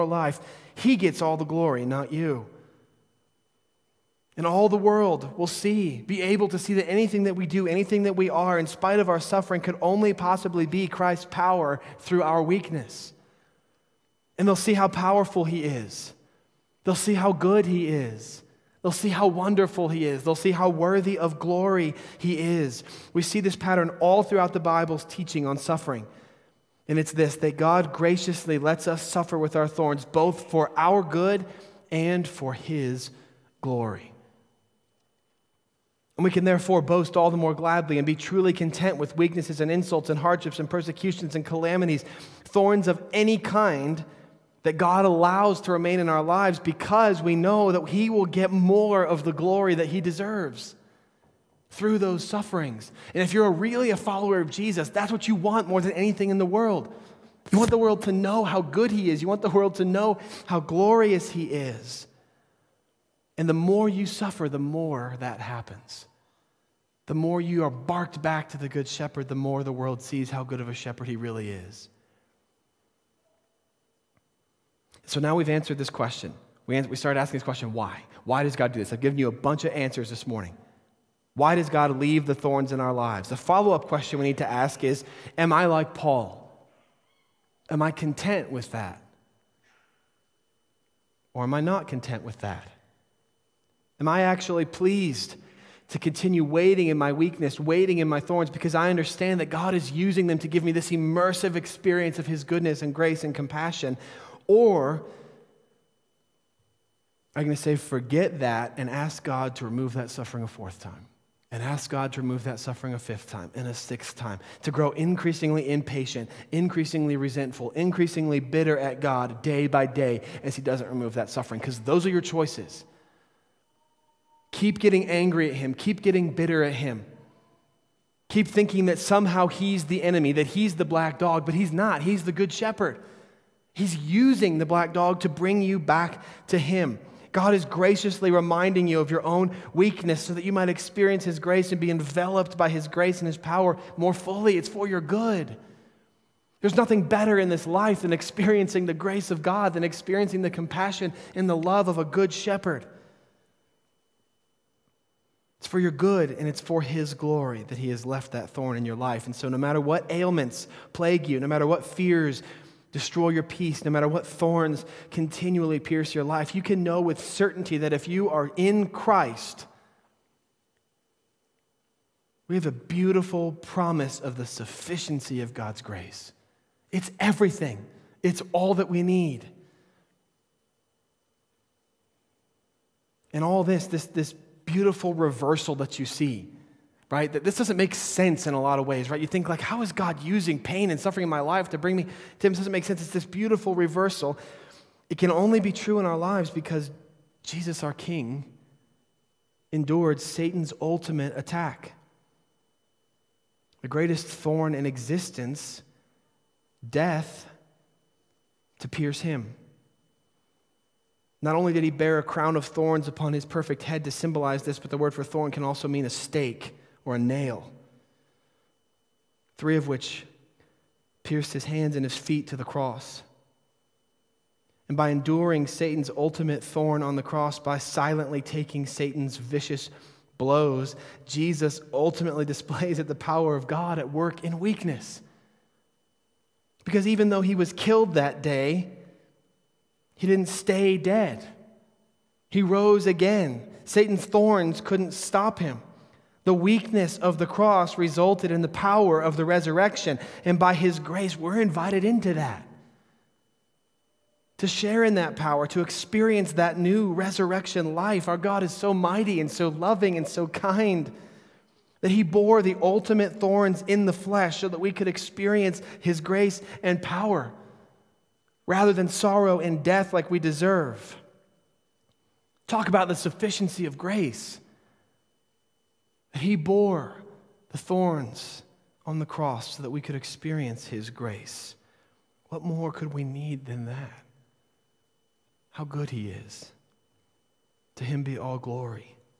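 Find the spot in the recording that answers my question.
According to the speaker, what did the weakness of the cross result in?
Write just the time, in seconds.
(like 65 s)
248 s.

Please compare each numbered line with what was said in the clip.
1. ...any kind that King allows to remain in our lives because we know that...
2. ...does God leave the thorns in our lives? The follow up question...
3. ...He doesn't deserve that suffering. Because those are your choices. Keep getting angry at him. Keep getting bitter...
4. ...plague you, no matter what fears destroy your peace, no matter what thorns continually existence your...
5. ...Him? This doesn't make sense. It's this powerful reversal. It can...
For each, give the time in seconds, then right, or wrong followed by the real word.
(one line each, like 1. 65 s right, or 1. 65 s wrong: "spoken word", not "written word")
1. 43 s wrong: "God", not "King"
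2. 81 s right
3. 120 s wrong: "remove", not "deserve"
4. 160 s wrong: "pierce", not "existence"
5. 192 s wrong: "beautiful", not "powerful".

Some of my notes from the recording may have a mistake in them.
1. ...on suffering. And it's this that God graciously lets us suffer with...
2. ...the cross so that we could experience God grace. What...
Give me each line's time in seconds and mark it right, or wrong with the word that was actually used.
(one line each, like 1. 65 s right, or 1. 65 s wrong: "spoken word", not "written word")
1. 25 s right
2. 279 s wrong: "His", not "God".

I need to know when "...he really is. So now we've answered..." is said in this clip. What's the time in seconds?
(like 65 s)
71 s.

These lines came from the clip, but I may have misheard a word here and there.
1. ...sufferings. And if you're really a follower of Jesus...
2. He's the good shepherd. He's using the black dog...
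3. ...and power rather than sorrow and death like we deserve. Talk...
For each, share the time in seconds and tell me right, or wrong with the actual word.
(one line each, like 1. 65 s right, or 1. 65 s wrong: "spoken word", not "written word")
1. 52 s right
2. 132 s right
3. 266 s right.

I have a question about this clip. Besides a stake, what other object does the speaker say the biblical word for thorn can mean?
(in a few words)
nail.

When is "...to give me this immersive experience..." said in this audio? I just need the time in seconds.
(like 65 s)
100 s.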